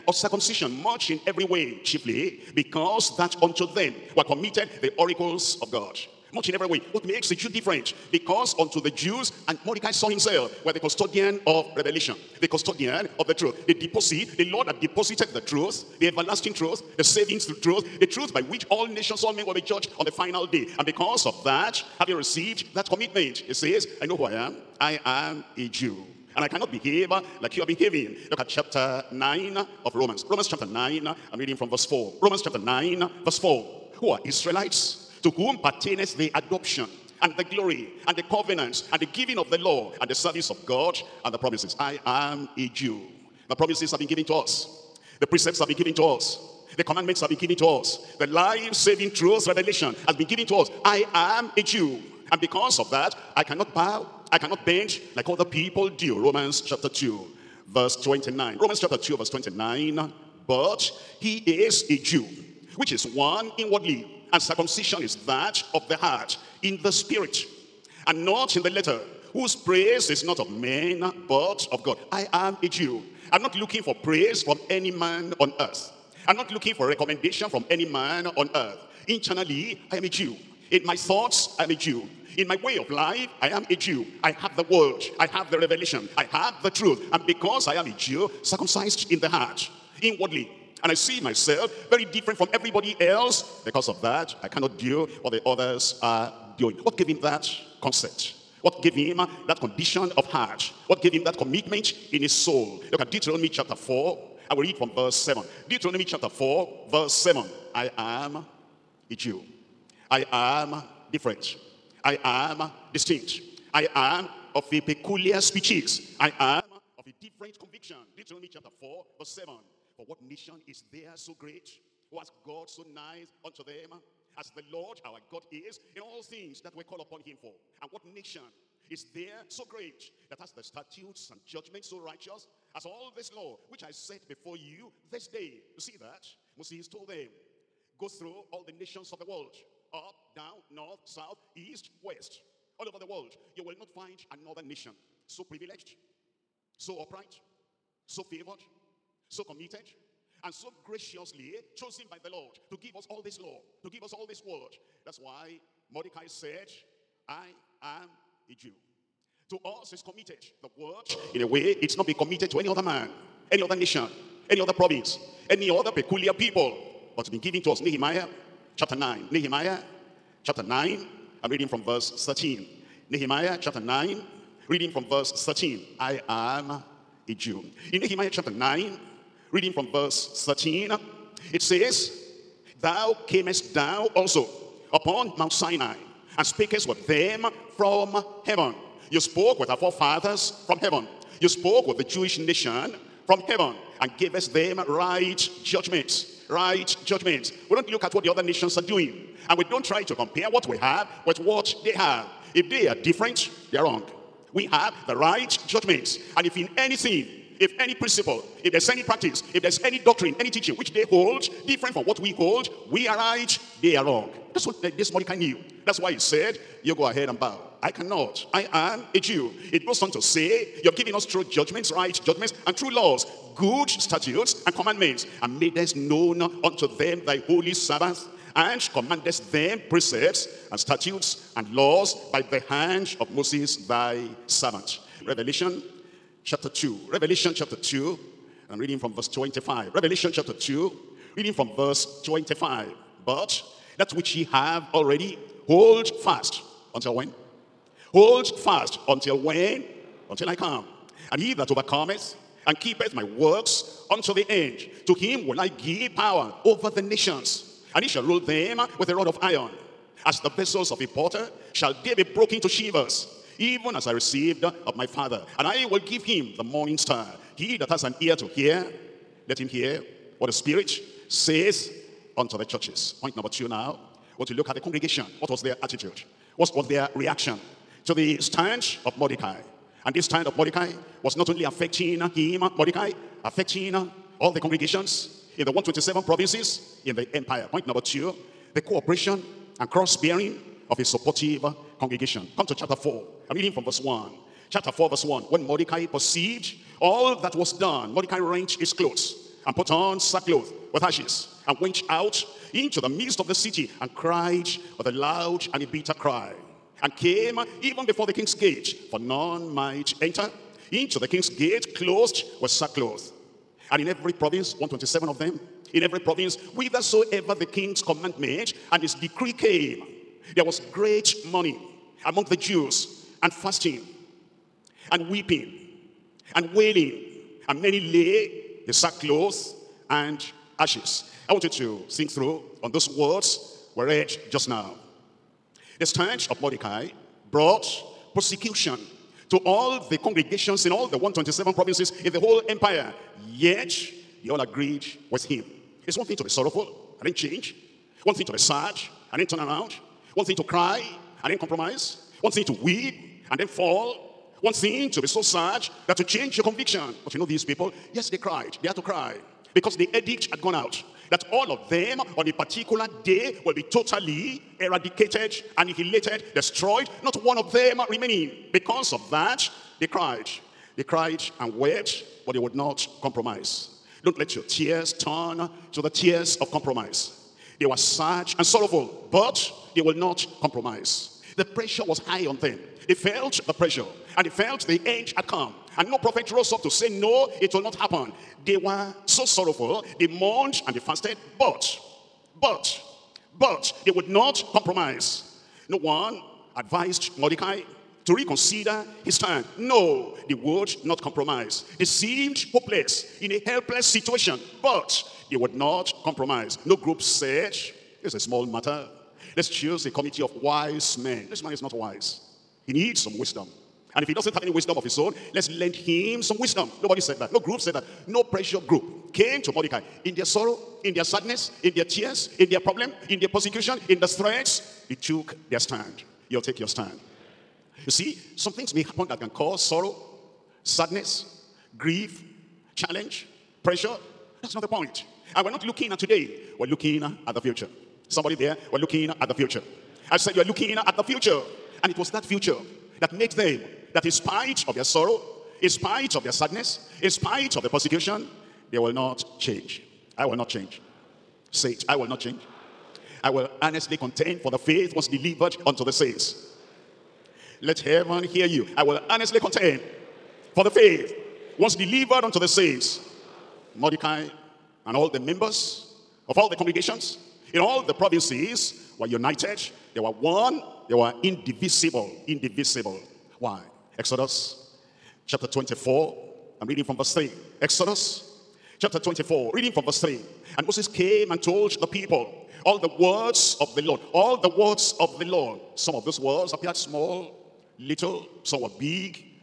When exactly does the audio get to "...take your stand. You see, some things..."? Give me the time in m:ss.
7:06.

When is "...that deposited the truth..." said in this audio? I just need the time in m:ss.
0:14.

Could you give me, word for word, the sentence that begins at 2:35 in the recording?
That's why Mordecai said, I am a Jew.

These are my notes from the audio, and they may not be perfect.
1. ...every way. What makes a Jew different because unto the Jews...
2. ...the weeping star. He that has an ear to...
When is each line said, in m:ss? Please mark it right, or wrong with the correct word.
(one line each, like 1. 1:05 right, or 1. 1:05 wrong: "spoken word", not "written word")
1. 0:06 right
2. 4:26 wrong: "morning", not "weeping".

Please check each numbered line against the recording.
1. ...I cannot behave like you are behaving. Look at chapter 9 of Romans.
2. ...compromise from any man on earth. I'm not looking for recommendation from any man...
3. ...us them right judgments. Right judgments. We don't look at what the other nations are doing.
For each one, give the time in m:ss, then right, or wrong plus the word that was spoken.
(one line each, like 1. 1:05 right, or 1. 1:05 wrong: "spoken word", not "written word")
1. 0:26 right
2. 1:14 wrong: "praise", not "compromise"
3. 3:14 right.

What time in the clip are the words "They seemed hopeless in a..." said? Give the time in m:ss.
6:41.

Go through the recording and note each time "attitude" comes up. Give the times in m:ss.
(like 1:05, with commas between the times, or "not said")
4:35.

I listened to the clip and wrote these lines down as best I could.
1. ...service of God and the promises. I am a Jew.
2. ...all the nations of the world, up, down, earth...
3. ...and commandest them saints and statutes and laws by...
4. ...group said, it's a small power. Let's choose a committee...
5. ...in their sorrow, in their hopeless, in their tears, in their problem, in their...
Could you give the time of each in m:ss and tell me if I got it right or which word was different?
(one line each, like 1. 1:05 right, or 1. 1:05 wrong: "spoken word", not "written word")
1. 0:40 right
2. 2:18 wrong: "north", not "earth"
3. 3:48 wrong: "precepts", not "saints"
4. 6:46 wrong: "matter", not "power"
5. 7:00 wrong: "sadness", not "hopeless".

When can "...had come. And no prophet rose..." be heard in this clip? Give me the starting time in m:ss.
6:25.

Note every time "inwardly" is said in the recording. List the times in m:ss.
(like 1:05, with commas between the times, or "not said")
1:03, 1:30.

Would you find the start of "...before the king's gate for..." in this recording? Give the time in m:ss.
5:08.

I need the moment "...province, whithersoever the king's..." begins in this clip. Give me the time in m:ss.
5:16.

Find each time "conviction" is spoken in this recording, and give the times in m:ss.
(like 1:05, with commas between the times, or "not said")
1:57, 5:56.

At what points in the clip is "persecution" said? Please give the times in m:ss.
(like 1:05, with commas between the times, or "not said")
5:38, 7:03, 7:27.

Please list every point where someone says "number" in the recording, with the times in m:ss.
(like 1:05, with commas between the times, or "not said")
4:33, 4:47.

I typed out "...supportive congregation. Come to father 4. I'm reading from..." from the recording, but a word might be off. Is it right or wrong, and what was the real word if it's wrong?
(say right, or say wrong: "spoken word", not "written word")
wrong: "chapter", not "father".